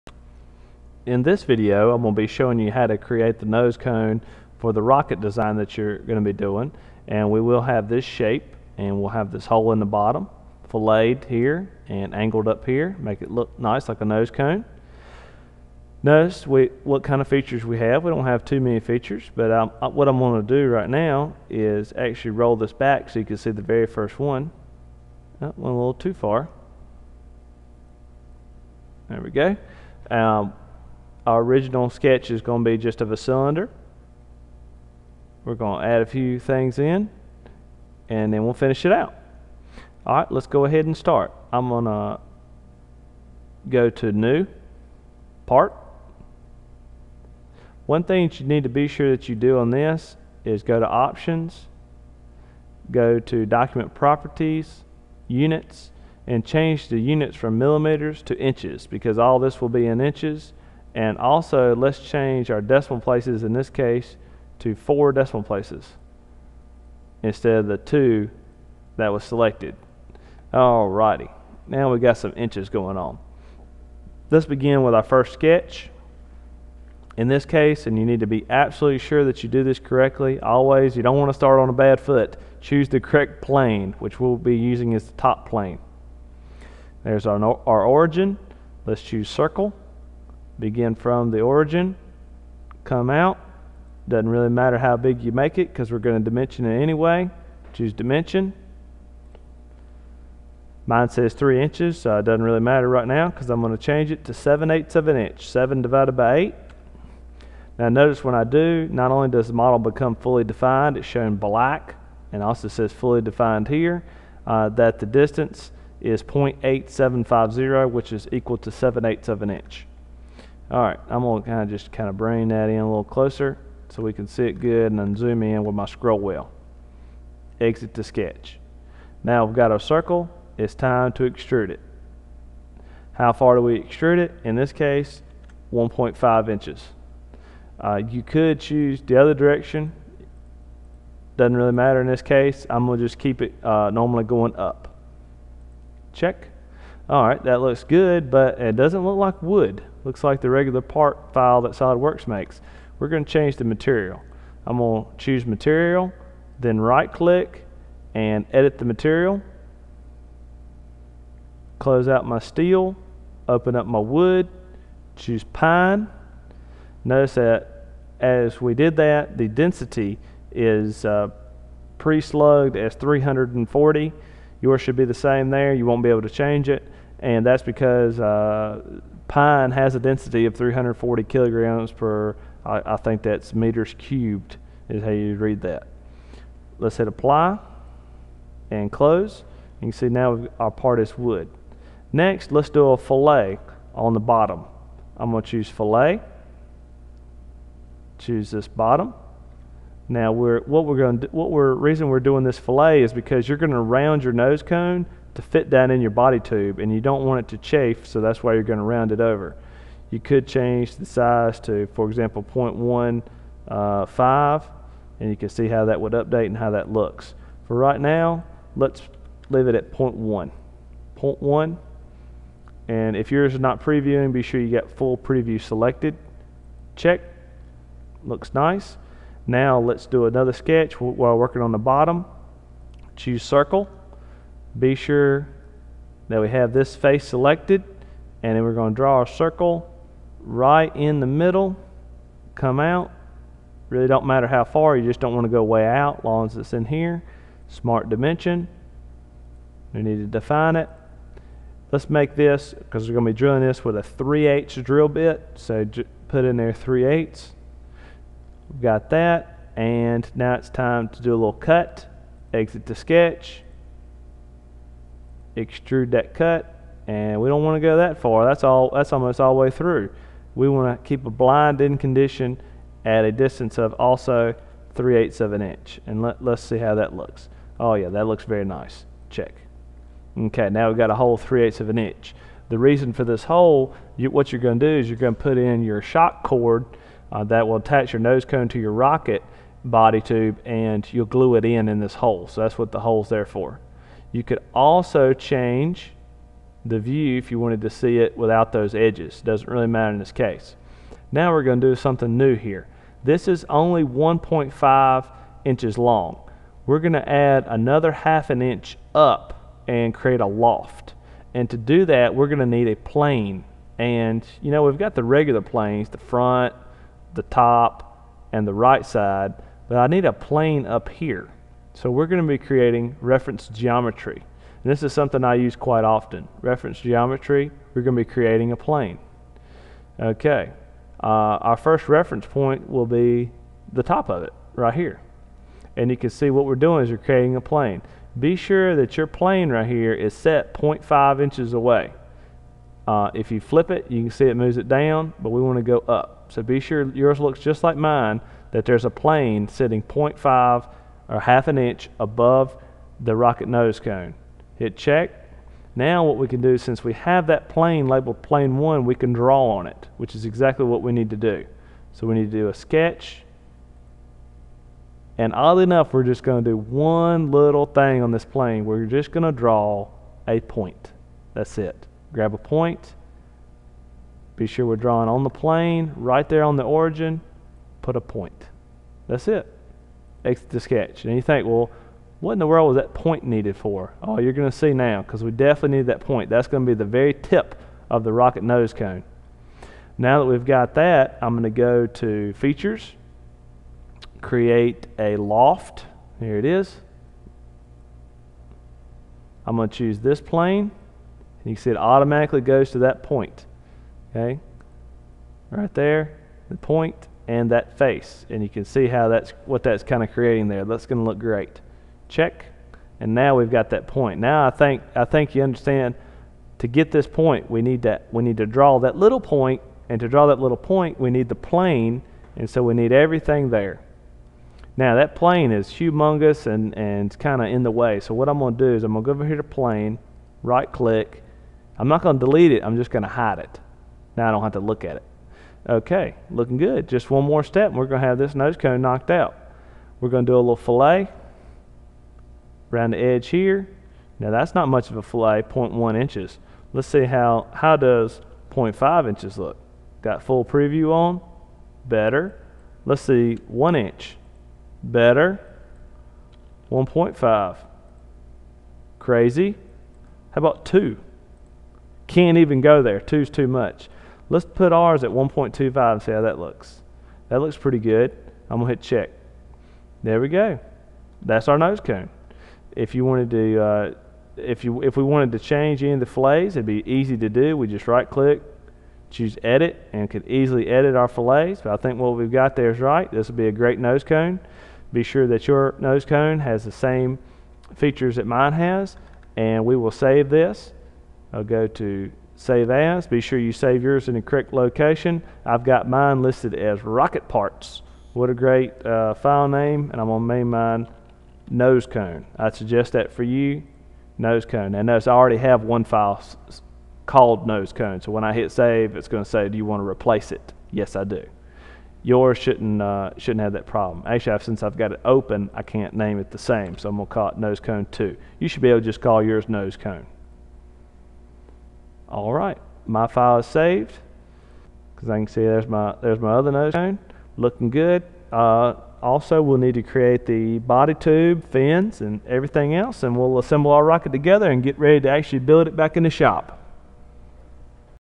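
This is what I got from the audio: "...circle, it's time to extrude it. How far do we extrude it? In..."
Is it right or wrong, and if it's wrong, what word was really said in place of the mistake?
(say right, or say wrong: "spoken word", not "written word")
right.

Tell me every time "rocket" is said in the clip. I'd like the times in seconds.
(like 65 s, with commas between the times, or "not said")
4 s, 288 s, 353 s, 388 s, 497 s, 534 s.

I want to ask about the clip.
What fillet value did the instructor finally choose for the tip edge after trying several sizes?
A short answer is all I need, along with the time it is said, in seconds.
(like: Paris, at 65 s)
1.25, at 465 s.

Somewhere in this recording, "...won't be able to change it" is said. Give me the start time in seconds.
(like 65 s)
175 s.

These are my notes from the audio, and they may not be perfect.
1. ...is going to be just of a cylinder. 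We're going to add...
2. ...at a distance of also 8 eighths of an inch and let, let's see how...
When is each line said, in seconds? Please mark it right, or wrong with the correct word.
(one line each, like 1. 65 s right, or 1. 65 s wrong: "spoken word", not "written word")
1. 32 s right
2. 273 s wrong: "3", not "8".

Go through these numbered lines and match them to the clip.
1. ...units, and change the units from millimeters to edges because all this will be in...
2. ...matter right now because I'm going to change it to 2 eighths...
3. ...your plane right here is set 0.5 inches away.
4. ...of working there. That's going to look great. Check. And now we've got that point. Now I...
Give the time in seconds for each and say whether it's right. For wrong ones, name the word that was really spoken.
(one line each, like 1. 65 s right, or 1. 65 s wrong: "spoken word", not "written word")
1. 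55 s wrong: "inches", not "edges"
2. 102 s wrong: "7", not "2"
3. 339 s right
4. 410 s wrong: "creating", not "working".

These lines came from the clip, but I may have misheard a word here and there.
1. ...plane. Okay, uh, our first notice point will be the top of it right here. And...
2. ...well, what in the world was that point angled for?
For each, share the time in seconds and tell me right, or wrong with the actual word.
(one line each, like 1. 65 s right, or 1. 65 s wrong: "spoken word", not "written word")
1. 328 s wrong: "reference", not "notice"
2. 381 s wrong: "needed", not "angled".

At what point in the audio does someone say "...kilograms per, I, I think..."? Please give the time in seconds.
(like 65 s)
181 s.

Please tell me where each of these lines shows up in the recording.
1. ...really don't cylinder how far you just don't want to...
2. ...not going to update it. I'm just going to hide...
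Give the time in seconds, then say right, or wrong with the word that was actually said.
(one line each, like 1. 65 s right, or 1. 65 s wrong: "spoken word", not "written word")
1. 243 s wrong: "matter", not "cylinder"
2. 432 s wrong: "delete", not "update".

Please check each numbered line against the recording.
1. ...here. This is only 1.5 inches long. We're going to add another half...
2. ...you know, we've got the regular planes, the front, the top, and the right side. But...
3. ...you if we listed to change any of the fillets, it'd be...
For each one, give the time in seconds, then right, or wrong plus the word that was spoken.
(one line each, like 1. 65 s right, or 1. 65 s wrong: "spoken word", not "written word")
1. 302 s right
2. 314 s right
3. 474 s wrong: "wanted", not "listed".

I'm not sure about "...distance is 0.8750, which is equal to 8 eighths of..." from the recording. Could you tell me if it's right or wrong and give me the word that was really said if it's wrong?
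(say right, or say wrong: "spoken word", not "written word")
wrong: "7", not "8".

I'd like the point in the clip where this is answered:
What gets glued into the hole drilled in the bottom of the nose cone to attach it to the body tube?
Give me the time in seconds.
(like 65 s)
286 s.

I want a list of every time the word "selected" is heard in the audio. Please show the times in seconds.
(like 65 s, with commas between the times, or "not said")
69 s, 225 s, 237 s.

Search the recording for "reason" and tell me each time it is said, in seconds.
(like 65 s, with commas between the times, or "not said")
201 s, 282 s.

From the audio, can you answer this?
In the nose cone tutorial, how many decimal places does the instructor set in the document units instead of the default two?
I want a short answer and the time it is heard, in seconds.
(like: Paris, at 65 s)
4, at 64 s.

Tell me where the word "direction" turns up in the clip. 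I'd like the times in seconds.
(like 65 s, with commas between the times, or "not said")
139 s.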